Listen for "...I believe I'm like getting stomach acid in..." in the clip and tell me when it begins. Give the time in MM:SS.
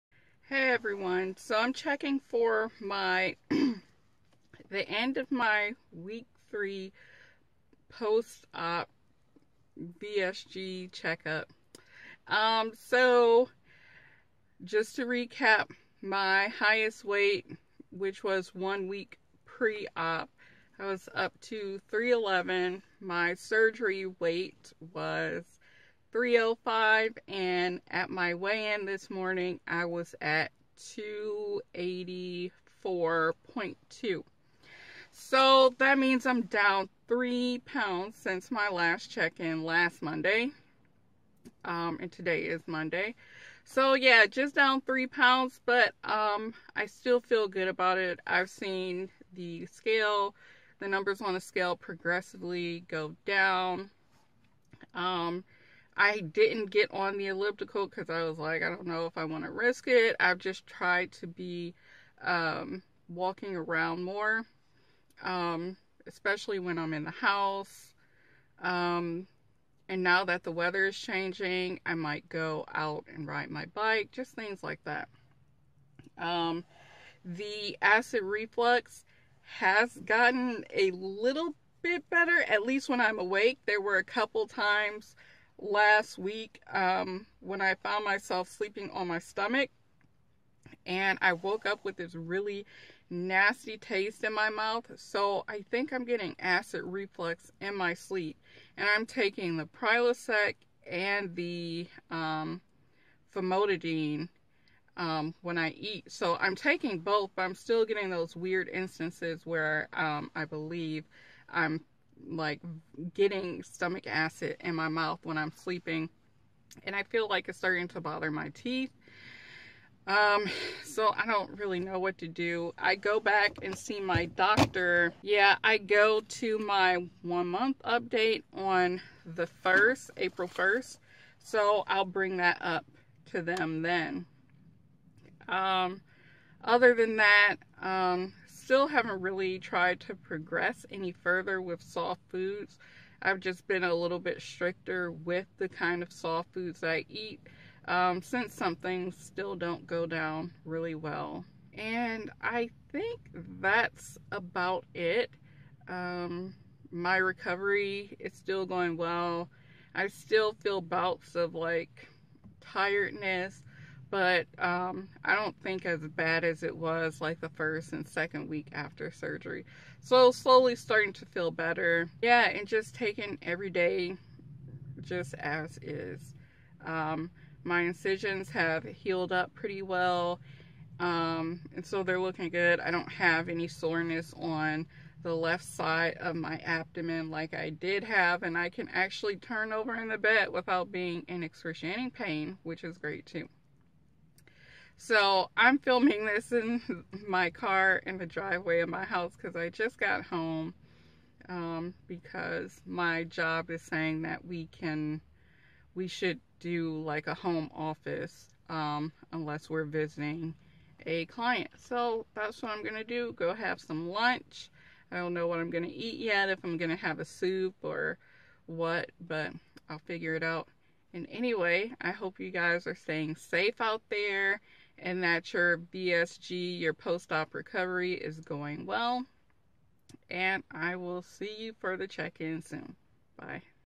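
01:50.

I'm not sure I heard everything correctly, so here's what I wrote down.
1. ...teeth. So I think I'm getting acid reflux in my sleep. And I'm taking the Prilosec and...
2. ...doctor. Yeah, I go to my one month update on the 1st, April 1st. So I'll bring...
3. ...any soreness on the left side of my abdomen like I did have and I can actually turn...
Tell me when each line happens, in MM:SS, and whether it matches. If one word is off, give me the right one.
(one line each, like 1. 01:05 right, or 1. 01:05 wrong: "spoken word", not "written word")
1. 01:34 wrong: "mouth", not "teeth"
2. 02:04 right
3. 03:03 right.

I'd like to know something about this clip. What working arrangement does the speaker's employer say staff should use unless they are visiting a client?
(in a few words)
Home office.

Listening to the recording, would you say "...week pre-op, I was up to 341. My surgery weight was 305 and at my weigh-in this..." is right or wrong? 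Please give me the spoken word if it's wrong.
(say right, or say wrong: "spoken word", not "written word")
wrong: "311", not "341".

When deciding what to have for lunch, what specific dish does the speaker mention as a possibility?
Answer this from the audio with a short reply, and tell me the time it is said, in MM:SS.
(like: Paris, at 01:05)
Soup, at 03:37.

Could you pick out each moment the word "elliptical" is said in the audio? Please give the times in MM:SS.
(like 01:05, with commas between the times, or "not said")
00:57.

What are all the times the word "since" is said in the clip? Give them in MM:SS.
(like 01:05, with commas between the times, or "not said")
00:38, 02:28.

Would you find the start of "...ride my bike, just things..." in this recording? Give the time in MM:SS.
01:13.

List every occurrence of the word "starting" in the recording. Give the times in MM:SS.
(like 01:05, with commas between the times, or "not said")
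01:57, 02:50.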